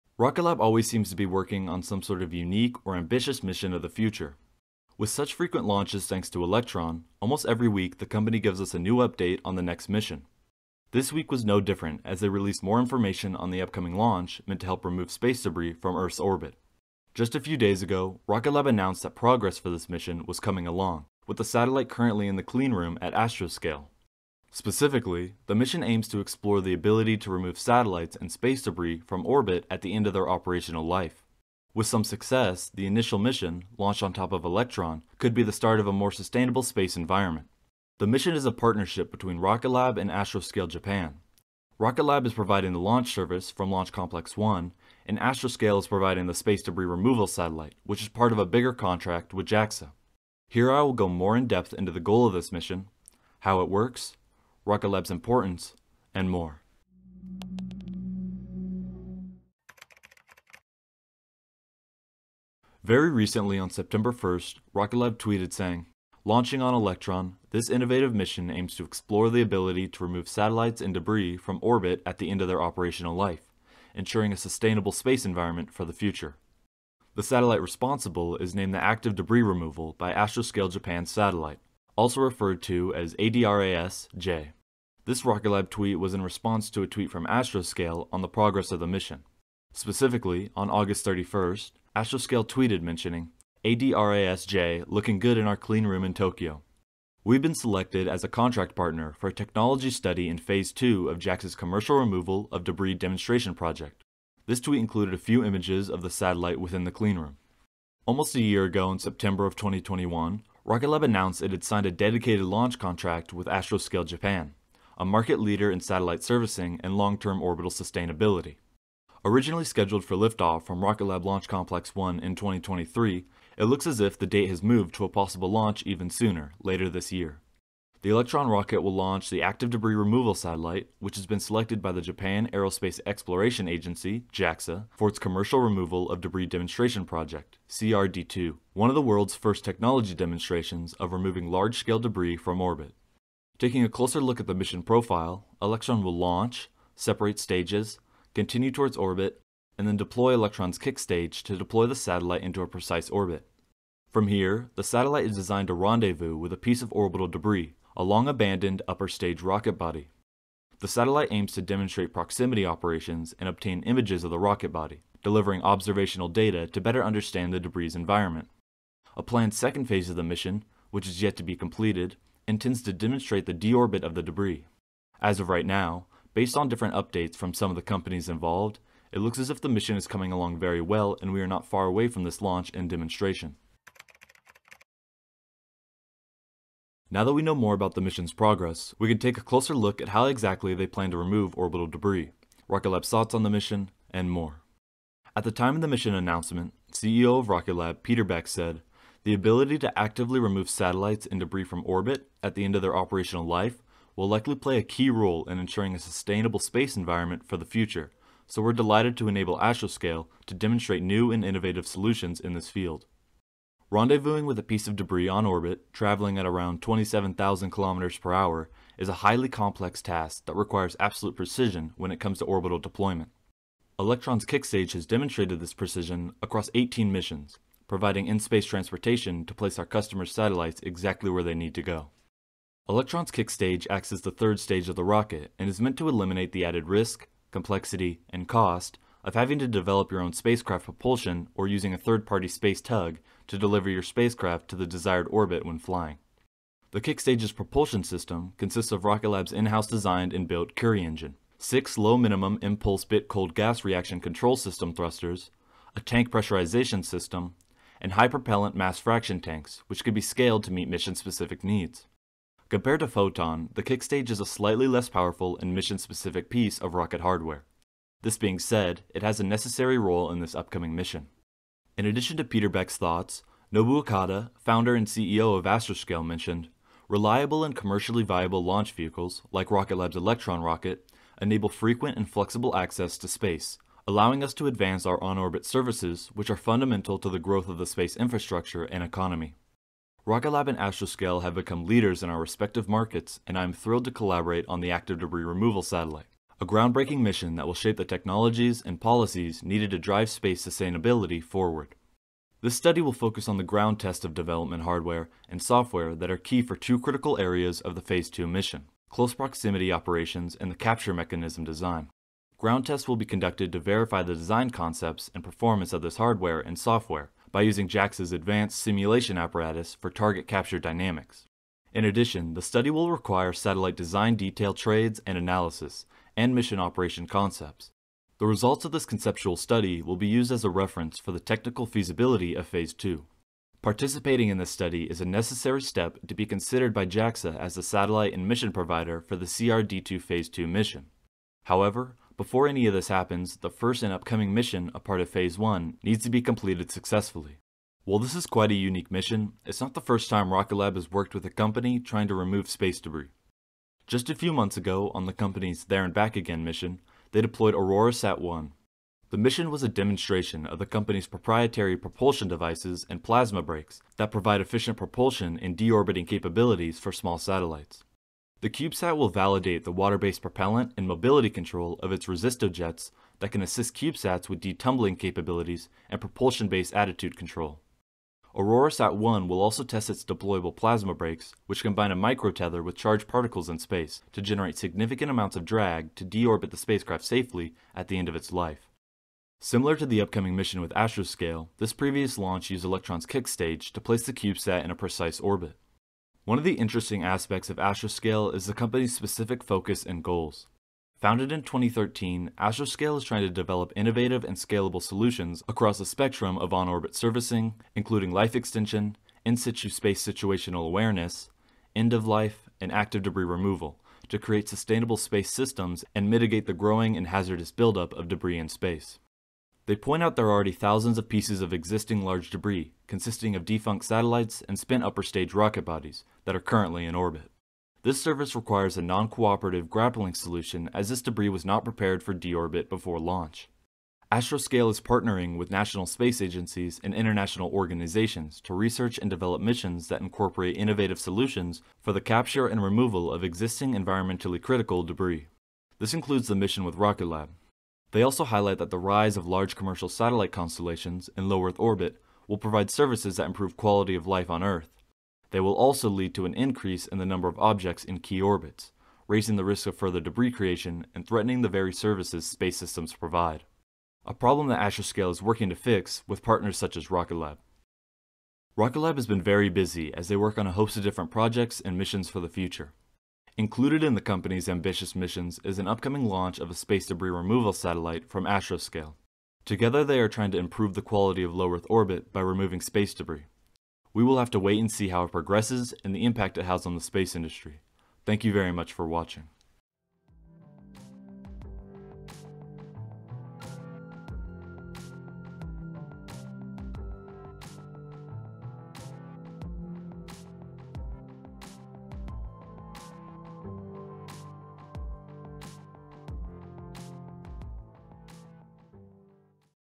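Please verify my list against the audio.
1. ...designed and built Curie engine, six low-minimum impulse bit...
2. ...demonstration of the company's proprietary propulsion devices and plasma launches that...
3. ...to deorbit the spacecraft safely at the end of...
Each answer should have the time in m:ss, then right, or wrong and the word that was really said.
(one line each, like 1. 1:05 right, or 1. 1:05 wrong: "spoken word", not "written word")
1. 4:09 right
2. 5:59 wrong: "brakes", not "launches"
3. 6:26 right.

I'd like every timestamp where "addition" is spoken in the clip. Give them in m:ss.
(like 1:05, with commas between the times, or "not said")
4:32, 5:22.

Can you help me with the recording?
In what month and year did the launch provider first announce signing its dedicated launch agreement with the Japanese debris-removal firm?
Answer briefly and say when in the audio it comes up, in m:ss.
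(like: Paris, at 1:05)
September 2021, at 1:48.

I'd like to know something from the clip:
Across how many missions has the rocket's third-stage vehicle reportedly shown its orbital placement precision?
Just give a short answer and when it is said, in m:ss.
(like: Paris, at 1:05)
18, at 3:46.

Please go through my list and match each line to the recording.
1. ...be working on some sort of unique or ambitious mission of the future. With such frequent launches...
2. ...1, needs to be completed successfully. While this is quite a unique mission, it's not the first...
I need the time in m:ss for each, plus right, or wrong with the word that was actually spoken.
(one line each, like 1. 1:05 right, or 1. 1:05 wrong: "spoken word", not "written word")
1. 0:01 right
2. 5:45 right.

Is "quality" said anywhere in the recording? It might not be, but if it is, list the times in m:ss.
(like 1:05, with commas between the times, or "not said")
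7:33, 8:01.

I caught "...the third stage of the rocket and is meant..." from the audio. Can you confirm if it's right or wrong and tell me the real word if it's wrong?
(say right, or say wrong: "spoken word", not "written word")
right.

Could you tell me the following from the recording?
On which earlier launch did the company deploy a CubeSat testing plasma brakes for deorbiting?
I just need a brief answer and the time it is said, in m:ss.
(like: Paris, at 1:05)
There and Back Again, at 5:55.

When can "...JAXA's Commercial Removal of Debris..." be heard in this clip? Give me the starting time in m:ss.
1:41.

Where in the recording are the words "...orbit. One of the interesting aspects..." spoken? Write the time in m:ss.
6:35.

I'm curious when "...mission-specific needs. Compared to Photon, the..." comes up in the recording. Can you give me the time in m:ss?
4:20.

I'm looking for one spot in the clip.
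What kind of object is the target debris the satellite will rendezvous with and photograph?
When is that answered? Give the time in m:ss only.
2:38.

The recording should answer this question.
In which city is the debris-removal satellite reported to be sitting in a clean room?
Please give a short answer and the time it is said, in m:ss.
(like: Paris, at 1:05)
Tokyo, at 1:36.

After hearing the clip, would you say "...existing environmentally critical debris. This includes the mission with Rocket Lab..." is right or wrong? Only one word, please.
right.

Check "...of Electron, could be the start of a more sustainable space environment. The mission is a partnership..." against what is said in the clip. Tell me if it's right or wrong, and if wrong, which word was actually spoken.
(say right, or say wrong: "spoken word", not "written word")
right.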